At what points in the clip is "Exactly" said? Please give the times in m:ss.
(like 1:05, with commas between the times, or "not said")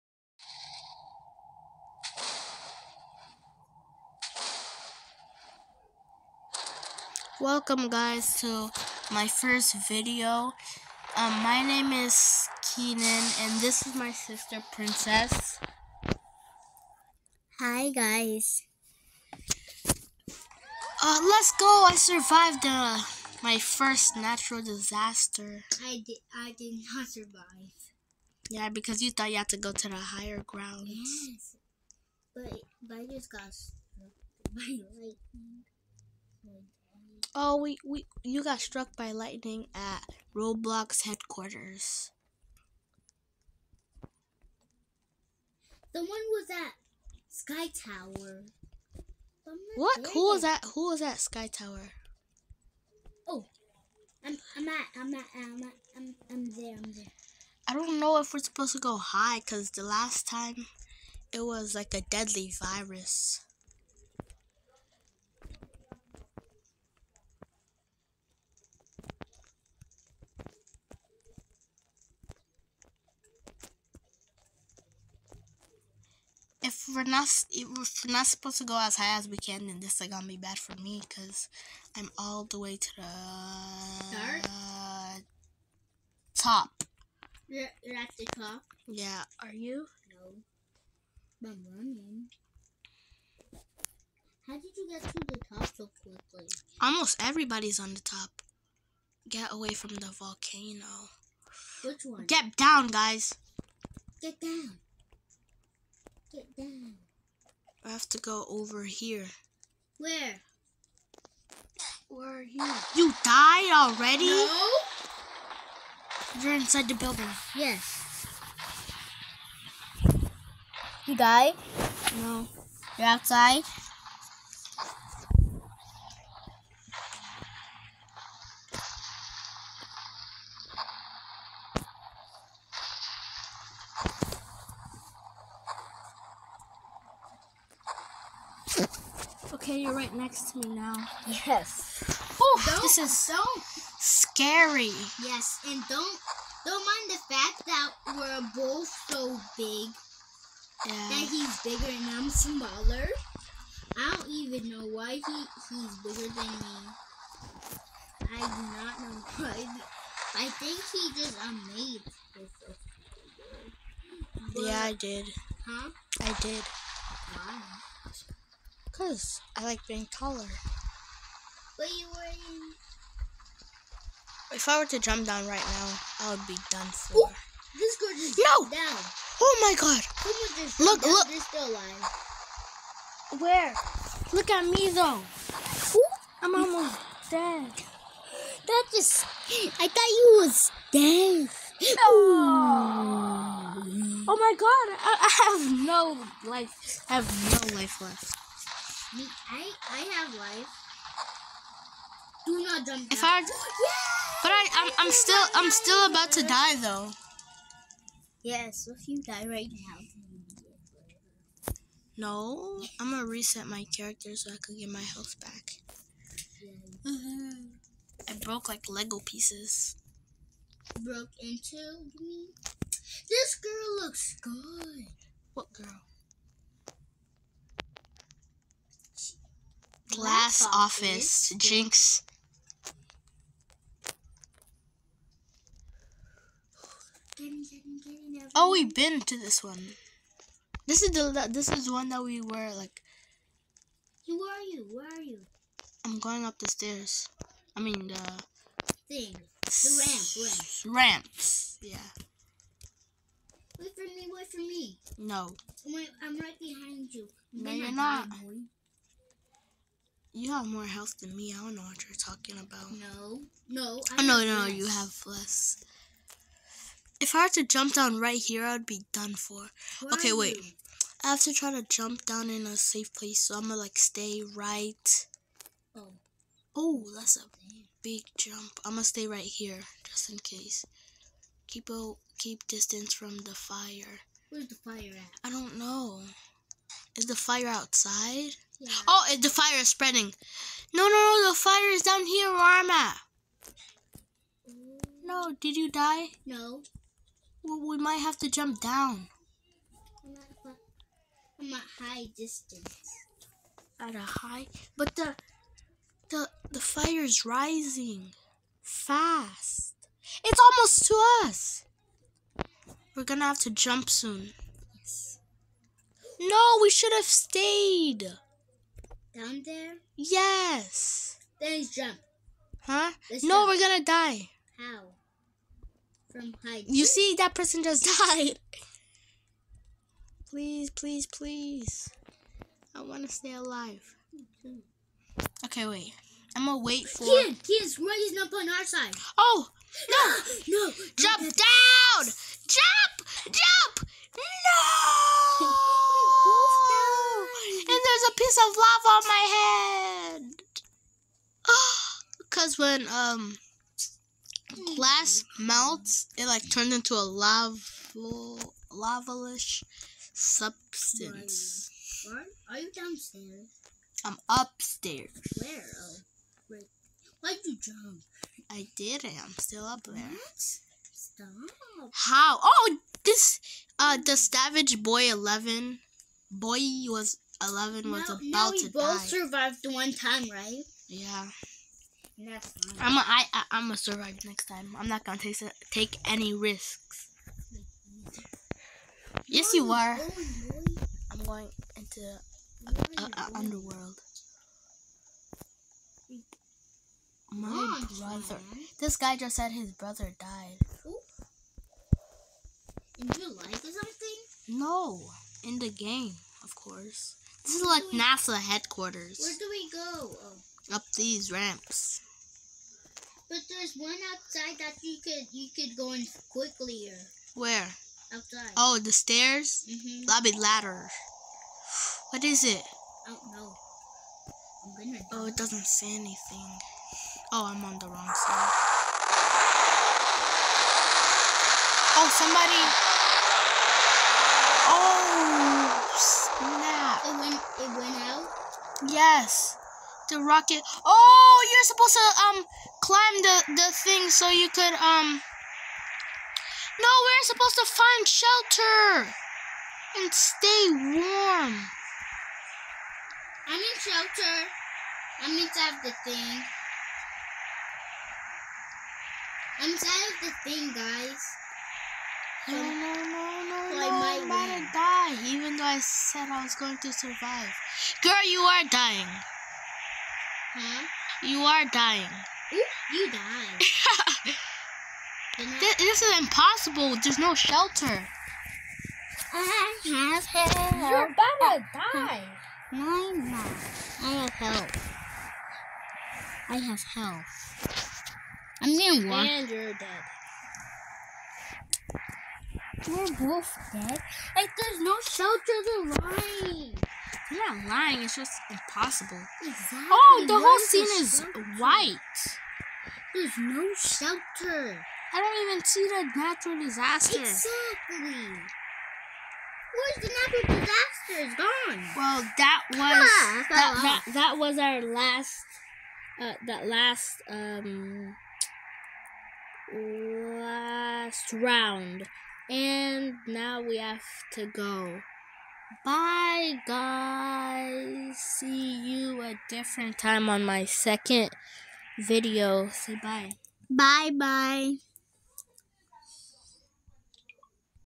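8:19, 8:27.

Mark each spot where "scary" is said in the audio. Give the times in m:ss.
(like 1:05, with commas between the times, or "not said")
2:23.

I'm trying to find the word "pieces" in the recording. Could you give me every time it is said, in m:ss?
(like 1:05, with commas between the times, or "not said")
3:39, 5:48.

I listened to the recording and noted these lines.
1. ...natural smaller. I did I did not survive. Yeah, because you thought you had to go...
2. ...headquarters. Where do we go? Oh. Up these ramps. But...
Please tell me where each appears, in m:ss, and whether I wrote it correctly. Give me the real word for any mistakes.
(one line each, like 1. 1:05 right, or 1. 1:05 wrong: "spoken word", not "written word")
1. 0:24 wrong: "disaster", not "smaller"
2. 6:48 right.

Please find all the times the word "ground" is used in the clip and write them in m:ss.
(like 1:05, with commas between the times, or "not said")
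0:30.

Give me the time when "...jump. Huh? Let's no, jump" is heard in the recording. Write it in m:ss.
5:21.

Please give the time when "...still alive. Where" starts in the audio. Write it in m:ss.
3:01.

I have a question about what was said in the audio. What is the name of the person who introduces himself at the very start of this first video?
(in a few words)
Keenan.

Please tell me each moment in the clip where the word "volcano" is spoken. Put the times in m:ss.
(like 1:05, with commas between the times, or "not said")
1:40.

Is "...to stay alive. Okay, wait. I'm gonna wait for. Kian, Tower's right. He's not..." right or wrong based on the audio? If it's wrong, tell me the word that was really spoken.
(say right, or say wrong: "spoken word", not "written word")
wrong: "Kian", not "Tower".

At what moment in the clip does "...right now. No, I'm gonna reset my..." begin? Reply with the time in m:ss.
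3:29.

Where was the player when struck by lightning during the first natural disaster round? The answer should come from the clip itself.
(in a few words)
Roblox headquarters.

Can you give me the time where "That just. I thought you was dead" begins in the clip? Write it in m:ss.
3:08.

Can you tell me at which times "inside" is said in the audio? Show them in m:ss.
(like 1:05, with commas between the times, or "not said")
1:56, 7:35, 7:39.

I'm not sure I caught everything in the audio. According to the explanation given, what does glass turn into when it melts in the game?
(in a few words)
lavalish substance.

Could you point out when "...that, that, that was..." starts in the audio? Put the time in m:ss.
8:33.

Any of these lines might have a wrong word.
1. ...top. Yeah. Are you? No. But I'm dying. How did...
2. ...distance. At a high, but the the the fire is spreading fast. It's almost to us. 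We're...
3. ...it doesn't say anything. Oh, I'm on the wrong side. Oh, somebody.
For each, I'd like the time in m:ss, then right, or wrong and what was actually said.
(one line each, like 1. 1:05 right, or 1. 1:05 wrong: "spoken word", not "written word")
1. 1:28 wrong: "running", not "dying"
2. 5:02 wrong: "rising", not "spreading"
3. 7:05 right.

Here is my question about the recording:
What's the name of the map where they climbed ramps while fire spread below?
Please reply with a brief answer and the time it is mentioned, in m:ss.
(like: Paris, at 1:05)
Glass office, at 3:50.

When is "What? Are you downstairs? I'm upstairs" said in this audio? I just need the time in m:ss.
6:02.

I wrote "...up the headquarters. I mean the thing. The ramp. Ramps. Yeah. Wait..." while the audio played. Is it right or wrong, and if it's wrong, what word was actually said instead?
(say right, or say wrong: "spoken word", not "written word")
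wrong: "stairs", not "headquarters".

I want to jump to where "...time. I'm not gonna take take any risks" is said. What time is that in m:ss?
6:24.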